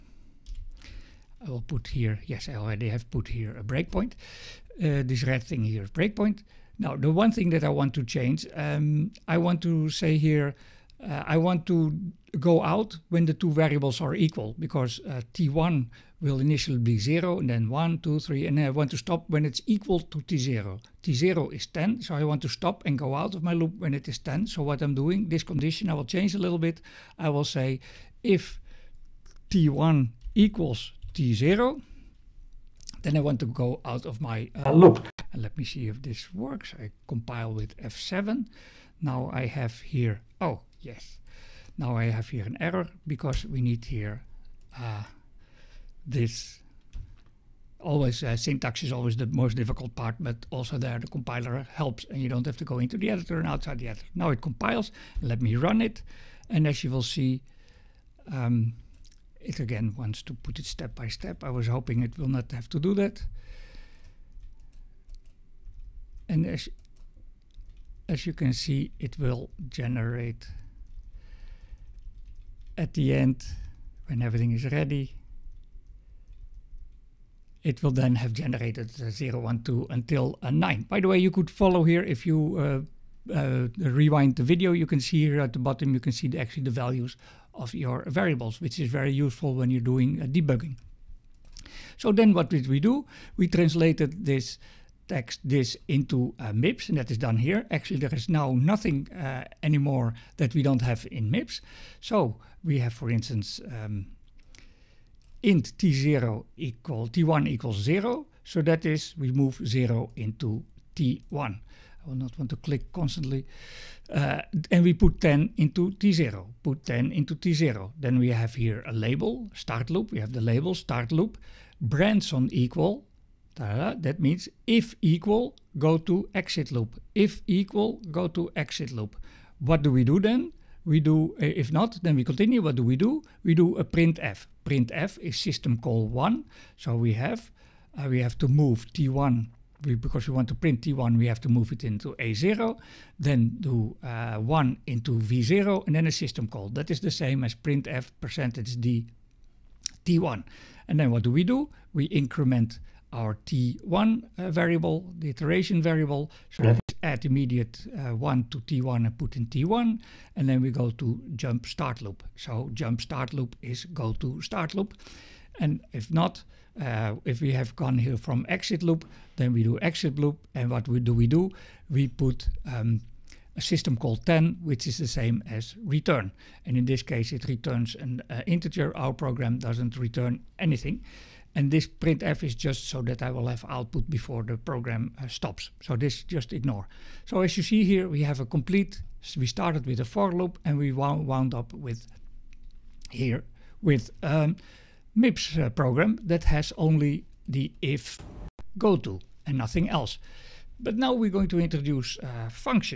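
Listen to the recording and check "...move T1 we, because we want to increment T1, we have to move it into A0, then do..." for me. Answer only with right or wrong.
wrong.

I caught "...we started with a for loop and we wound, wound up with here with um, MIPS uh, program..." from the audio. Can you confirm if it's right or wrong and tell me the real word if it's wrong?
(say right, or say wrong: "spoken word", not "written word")
right.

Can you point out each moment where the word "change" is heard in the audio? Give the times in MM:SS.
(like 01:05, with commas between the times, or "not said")
00:08, 00:26.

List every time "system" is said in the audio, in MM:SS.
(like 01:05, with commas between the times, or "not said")
02:15, 02:26, 02:53.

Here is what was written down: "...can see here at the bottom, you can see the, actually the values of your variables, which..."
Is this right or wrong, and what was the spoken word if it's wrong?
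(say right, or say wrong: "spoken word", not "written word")
right.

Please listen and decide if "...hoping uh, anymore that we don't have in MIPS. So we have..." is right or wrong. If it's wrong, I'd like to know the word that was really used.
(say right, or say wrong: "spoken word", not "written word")
wrong: "nothing", not "hoping".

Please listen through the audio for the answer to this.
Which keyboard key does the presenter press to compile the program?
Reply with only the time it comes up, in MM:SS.
00:37.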